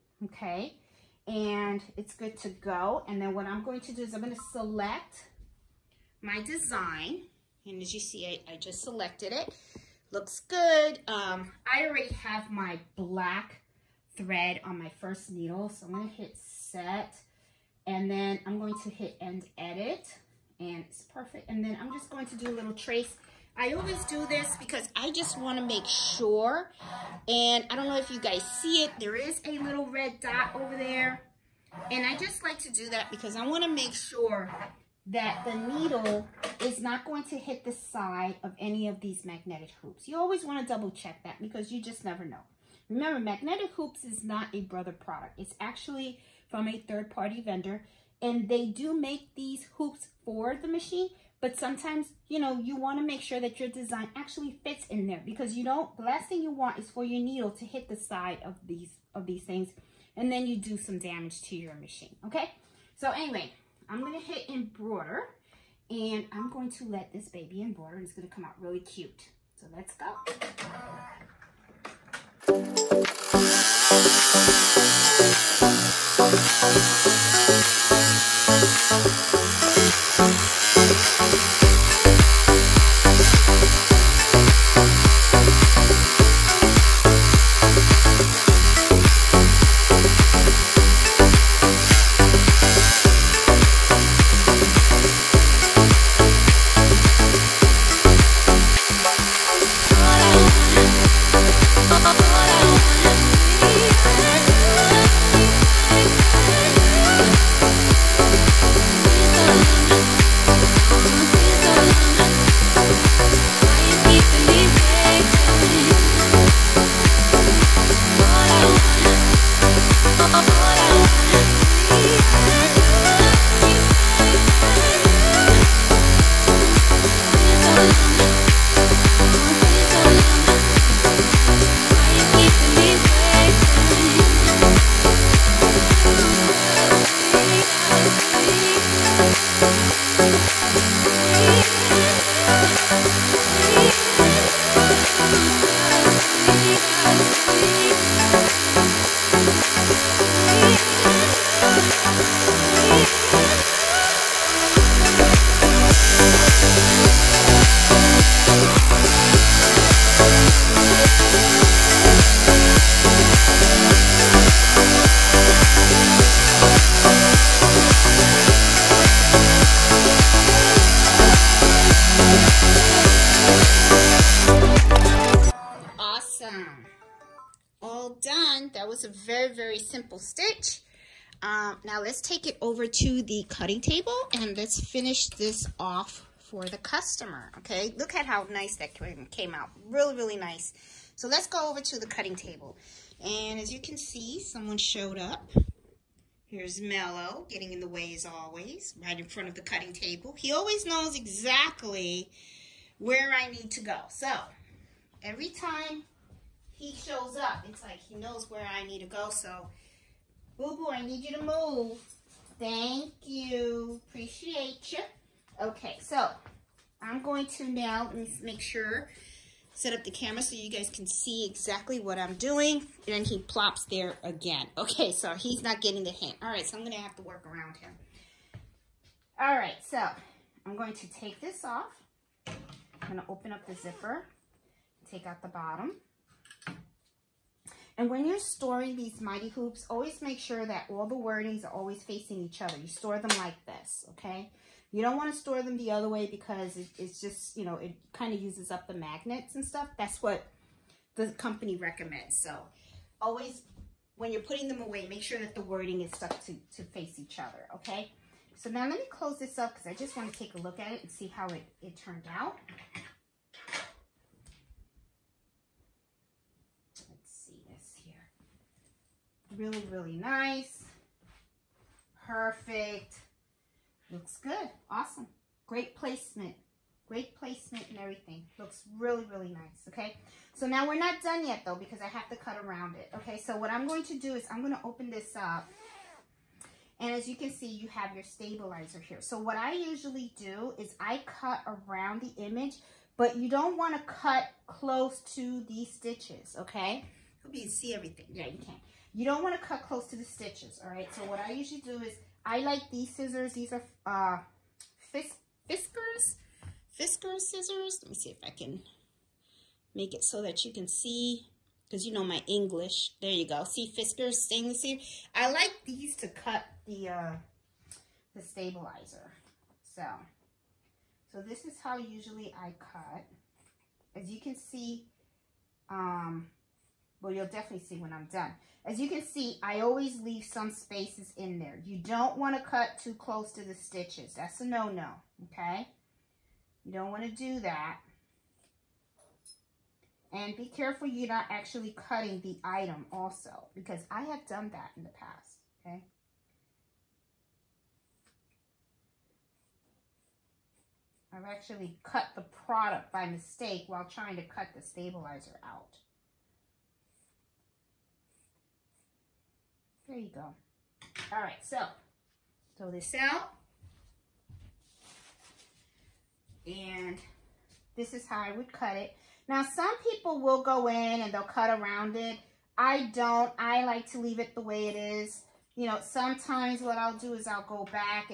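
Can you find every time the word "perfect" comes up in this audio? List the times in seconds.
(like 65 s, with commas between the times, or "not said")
21 s, 272 s.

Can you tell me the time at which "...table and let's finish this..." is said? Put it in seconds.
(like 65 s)
183 s.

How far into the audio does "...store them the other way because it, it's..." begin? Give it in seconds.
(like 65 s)
245 s.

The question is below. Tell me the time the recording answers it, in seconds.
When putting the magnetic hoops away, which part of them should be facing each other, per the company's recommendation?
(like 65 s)
241 s.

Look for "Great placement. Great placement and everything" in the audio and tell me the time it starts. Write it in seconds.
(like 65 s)
275 s.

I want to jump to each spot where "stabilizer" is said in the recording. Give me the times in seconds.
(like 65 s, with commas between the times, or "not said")
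288 s, 318 s, 354 s.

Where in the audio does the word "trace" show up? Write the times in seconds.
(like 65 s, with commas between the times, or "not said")
22 s.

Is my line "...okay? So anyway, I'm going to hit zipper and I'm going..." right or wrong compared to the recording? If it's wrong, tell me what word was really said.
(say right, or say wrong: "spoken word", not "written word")
wrong: "embroider", not "zipper".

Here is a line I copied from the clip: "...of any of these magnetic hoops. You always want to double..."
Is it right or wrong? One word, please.
right.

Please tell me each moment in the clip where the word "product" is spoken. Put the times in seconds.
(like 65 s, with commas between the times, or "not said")
44 s, 352 s.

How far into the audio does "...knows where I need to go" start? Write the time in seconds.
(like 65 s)
208 s.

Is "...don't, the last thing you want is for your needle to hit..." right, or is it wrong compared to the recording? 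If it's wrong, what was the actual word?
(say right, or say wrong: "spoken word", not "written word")
right.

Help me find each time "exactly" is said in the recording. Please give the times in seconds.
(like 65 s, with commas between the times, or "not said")
201 s, 221 s.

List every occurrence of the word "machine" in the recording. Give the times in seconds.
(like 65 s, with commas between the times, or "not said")
50 s, 61 s.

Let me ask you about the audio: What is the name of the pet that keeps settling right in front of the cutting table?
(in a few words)
Mello.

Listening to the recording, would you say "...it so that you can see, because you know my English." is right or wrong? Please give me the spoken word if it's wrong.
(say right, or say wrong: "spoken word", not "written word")
right.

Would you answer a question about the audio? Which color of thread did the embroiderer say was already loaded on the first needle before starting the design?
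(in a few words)
Black.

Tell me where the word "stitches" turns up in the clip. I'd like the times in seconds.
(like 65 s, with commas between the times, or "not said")
295 s, 300 s, 333 s.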